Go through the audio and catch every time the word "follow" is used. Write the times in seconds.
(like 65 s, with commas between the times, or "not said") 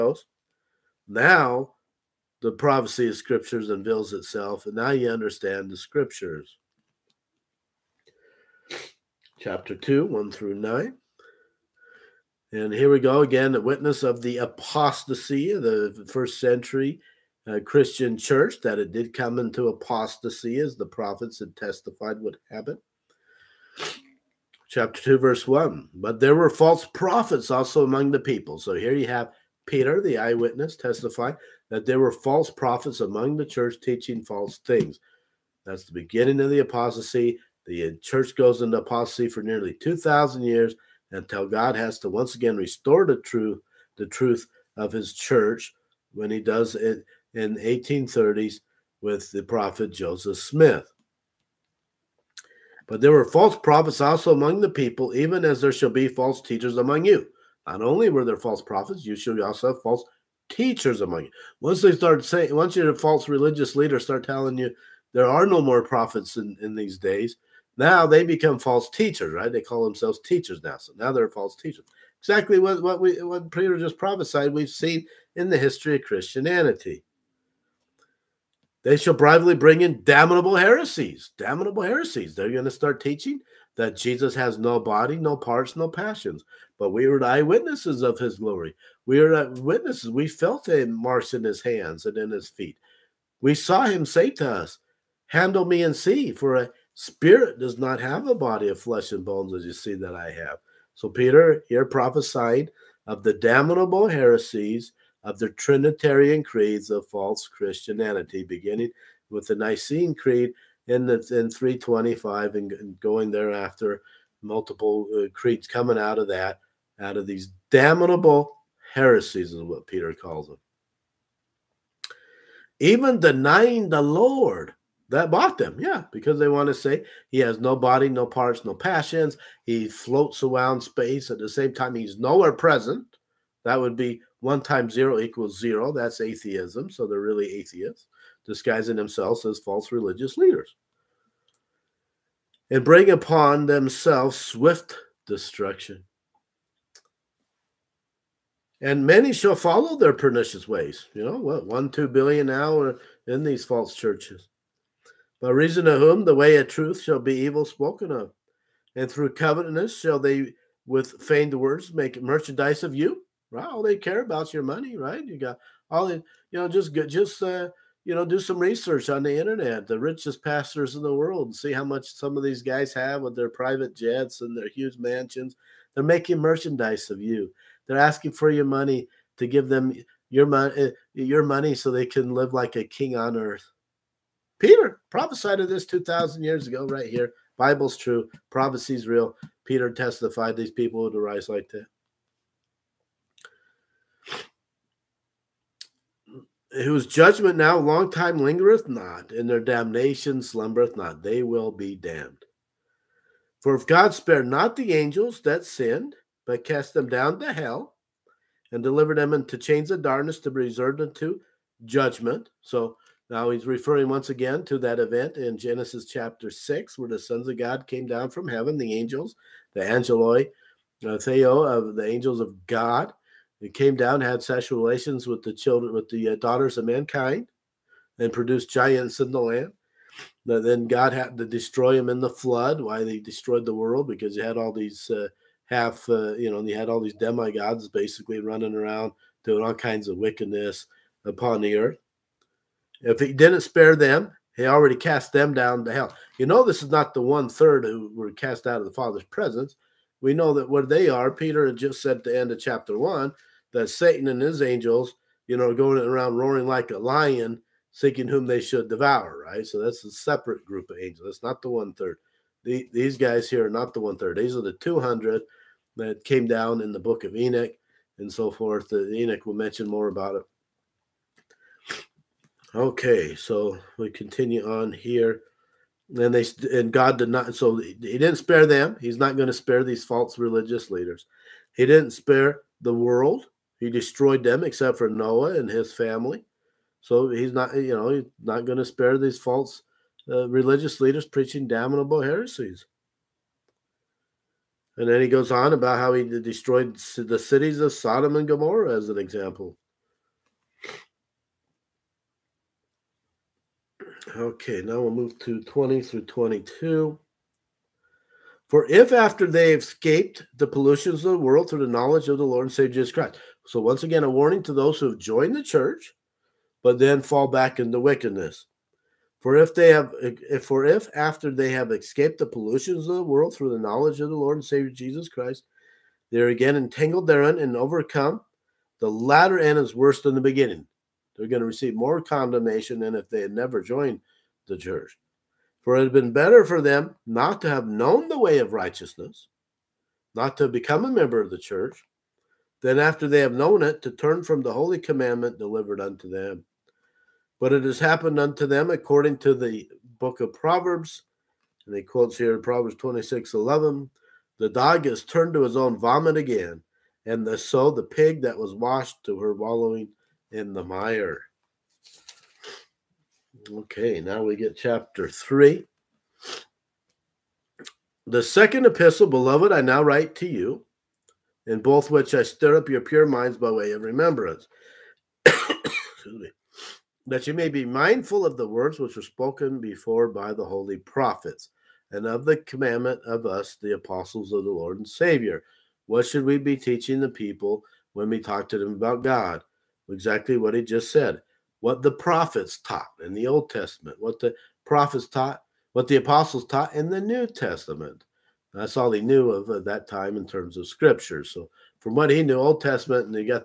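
149 s.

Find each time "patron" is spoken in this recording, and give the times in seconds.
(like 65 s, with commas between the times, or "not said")
not said.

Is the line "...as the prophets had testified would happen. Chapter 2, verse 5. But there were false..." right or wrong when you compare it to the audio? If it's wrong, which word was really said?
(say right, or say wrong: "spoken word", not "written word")
wrong: "1", not "5".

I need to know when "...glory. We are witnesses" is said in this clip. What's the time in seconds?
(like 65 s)
88 s.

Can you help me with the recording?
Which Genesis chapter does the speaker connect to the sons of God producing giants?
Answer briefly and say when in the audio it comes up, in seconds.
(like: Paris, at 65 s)
Chapter 6, at 215 s.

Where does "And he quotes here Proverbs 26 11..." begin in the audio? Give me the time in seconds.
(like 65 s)
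351 s.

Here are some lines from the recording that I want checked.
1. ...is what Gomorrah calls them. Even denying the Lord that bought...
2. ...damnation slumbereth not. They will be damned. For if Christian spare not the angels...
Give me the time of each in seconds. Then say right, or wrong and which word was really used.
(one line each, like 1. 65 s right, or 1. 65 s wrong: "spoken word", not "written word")
1. 119 s wrong: "Peter", not "Gomorrah"
2. 199 s wrong: "God", not "Christian".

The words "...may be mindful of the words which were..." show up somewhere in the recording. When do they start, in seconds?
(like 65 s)
377 s.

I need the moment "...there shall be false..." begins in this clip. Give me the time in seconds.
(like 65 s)
55 s.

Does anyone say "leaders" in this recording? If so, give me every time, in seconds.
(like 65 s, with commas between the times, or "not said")
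63 s, 140 s, 280 s, 290 s.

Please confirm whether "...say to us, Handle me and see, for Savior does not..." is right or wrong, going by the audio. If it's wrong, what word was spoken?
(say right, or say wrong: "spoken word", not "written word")
wrong: "Spirit", not "Savior".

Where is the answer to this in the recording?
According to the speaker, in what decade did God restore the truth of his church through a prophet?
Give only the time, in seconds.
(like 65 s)
47 s.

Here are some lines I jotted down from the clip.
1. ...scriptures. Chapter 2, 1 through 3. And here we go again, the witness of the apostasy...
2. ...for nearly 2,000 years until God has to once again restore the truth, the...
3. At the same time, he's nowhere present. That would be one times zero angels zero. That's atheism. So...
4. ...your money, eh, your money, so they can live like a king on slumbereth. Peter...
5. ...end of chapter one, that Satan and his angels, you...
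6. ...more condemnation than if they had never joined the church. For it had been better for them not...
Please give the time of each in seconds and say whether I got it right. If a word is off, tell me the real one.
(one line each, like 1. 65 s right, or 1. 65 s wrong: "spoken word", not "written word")
1. 5 s wrong: "9", not "3"
2. 39 s right
3. 131 s wrong: "equals", not "angels"
4. 180 s wrong: "earth", not "slumbereth"
5. 252 s right
6. 331 s right.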